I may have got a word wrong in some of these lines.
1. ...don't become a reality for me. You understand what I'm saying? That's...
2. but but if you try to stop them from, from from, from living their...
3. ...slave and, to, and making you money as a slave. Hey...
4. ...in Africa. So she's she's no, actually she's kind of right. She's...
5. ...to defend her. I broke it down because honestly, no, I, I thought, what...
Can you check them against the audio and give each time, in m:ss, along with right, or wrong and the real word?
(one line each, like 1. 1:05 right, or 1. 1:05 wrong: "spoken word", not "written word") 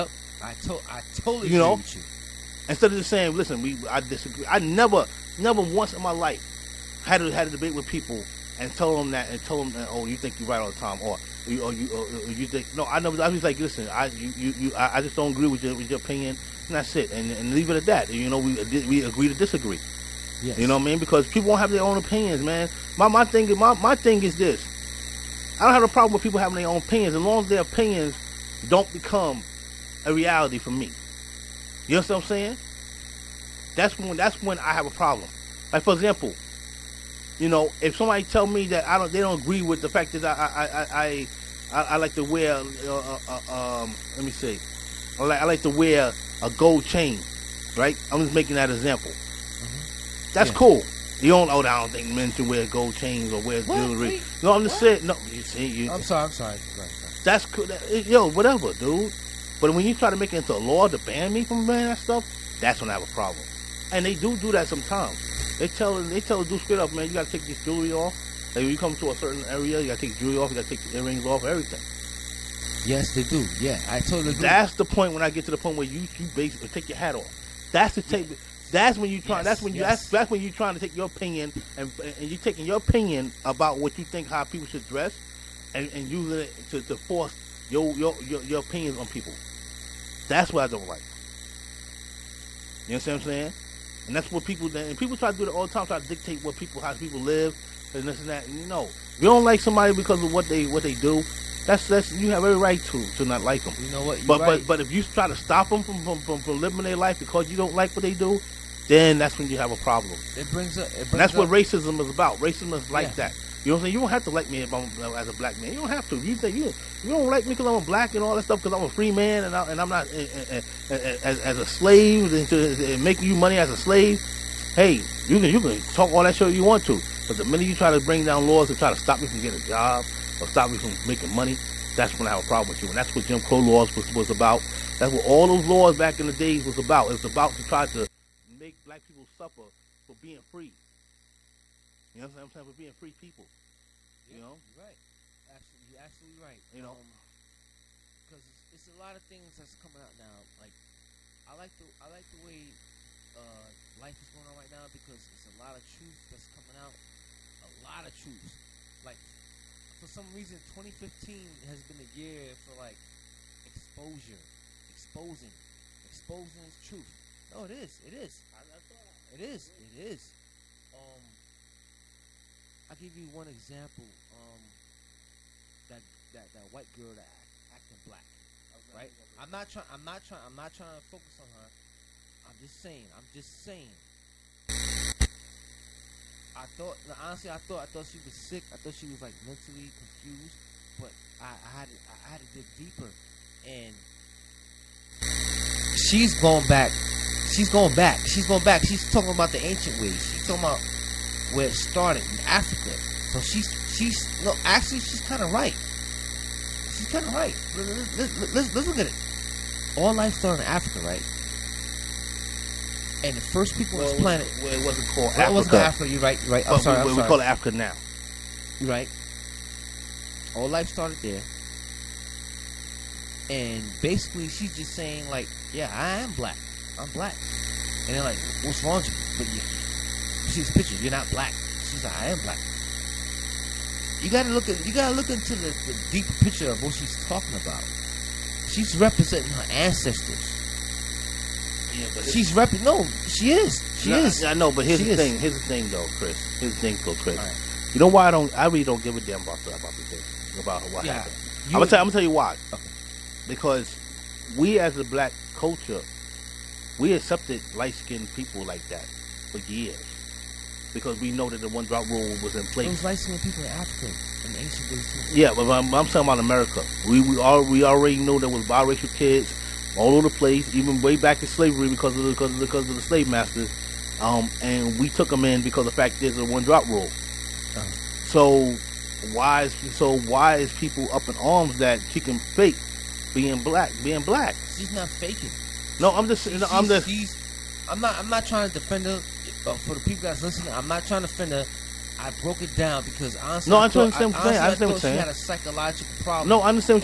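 1. 0:28 right
2. 1:44 right
3. 2:01 right
4. 3:22 right
5. 4:51 wrong: "offend", not "defend".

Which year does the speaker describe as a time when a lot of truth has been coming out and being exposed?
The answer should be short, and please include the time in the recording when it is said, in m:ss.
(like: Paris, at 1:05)
2015, at 2:40.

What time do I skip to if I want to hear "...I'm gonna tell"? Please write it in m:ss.
4:11.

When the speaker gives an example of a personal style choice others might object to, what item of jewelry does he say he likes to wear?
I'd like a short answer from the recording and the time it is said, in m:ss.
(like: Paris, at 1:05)
gold chain, at 0:46.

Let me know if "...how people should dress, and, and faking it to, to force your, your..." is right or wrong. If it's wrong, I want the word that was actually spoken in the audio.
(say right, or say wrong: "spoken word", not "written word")
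wrong: "using", not "faking".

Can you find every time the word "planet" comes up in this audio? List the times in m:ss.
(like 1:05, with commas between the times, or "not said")
3:34.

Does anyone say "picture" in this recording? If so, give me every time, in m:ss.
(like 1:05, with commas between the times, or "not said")
3:50, 3:56.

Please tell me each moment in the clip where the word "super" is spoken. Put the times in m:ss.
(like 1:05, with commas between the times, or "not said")
not said.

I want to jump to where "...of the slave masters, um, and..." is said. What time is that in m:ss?
4:32.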